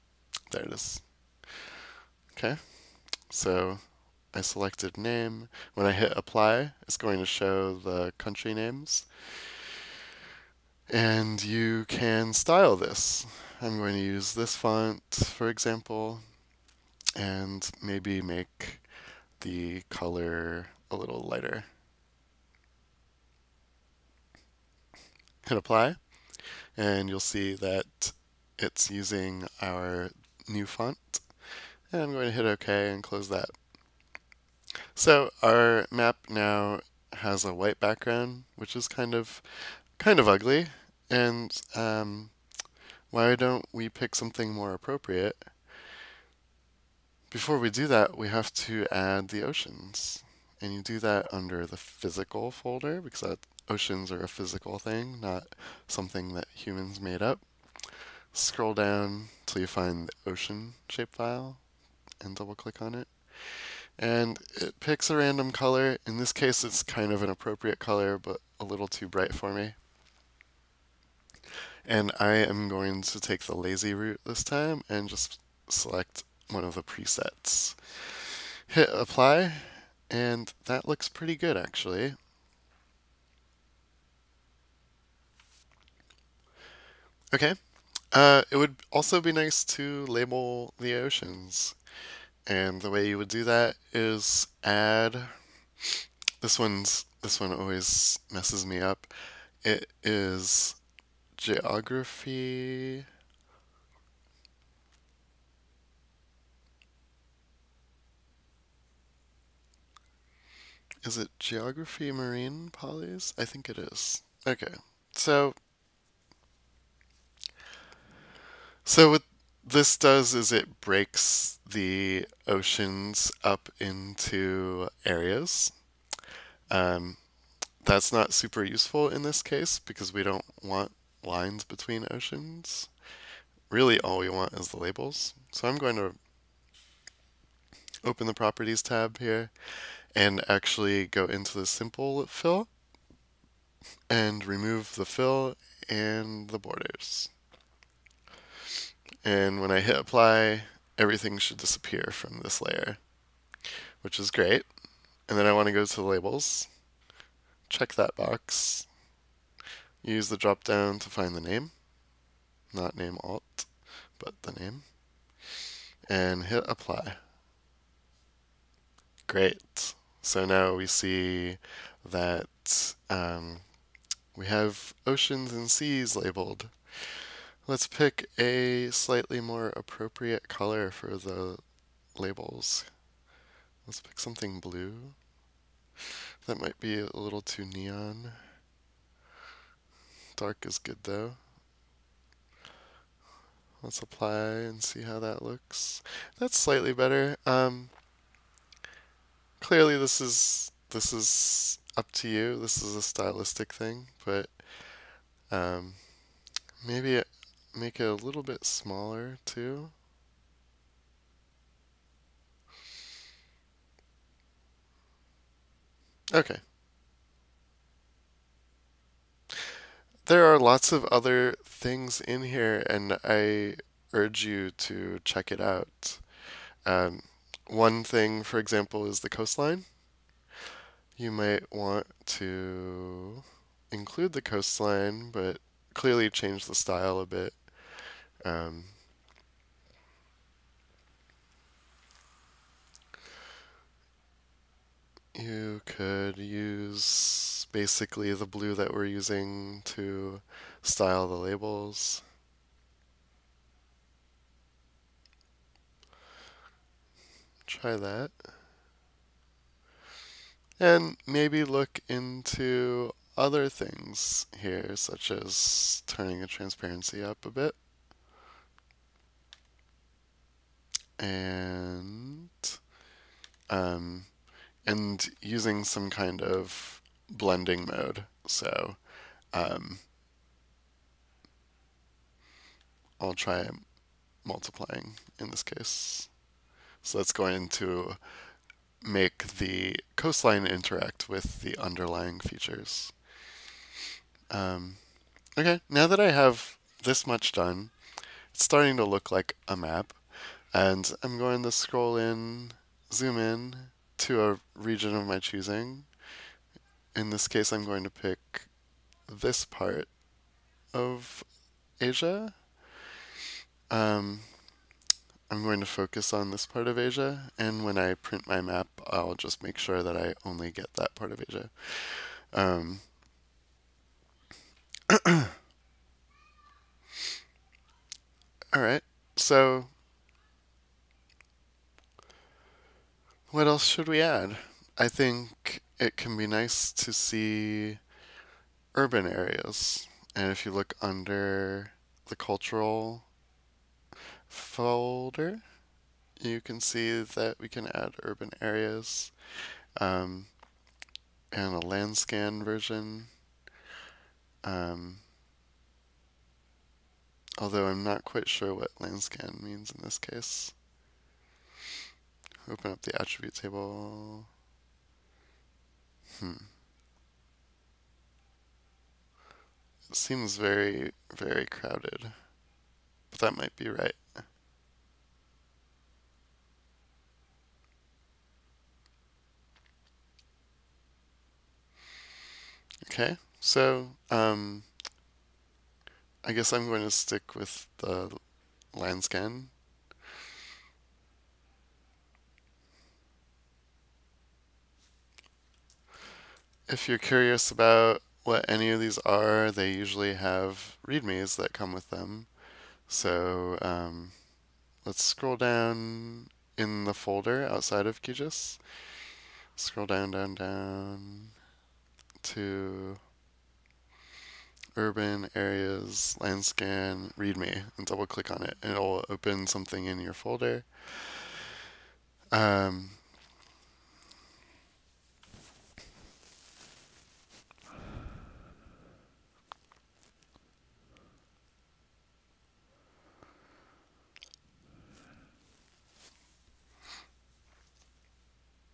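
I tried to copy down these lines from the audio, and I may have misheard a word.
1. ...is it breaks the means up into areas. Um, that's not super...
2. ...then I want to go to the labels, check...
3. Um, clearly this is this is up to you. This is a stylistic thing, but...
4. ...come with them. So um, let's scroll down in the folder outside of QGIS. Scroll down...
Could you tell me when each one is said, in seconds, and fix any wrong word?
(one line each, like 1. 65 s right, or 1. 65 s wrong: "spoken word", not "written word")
1. 120 s wrong: "oceans", not "means"
2. 155 s right
3. 197 s right
4. 401 s right.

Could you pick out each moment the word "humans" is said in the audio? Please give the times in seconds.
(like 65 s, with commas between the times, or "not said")
56 s.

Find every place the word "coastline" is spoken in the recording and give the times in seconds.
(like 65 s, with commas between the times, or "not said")
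229 s, 234 s, 290 s.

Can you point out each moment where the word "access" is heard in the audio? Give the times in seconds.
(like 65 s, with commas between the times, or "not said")
not said.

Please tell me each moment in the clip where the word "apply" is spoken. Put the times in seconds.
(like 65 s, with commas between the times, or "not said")
6 s, 25 s, 78 s, 149 s, 166 s, 194 s.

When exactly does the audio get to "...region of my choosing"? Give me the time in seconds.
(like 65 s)
304 s.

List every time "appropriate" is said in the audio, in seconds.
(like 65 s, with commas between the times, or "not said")
44 s, 67 s, 179 s.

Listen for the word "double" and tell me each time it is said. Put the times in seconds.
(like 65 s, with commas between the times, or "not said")
62 s, 418 s.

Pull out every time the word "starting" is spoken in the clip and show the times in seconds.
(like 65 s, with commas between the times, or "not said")
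298 s.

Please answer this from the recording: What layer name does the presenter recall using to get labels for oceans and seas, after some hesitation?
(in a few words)
geography marine polys.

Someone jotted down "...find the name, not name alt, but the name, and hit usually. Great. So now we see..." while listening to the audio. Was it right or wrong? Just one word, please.
wrong.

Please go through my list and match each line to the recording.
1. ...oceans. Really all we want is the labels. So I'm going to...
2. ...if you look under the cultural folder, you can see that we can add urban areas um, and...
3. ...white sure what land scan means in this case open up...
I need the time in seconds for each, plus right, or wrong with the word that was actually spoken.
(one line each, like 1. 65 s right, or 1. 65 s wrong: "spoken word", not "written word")
1. 132 s right
2. 340 s right
3. 358 s wrong: "quite", not "white".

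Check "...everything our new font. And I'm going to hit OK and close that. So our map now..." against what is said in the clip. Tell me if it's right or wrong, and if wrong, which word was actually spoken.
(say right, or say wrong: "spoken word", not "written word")
wrong: "using", not "everything".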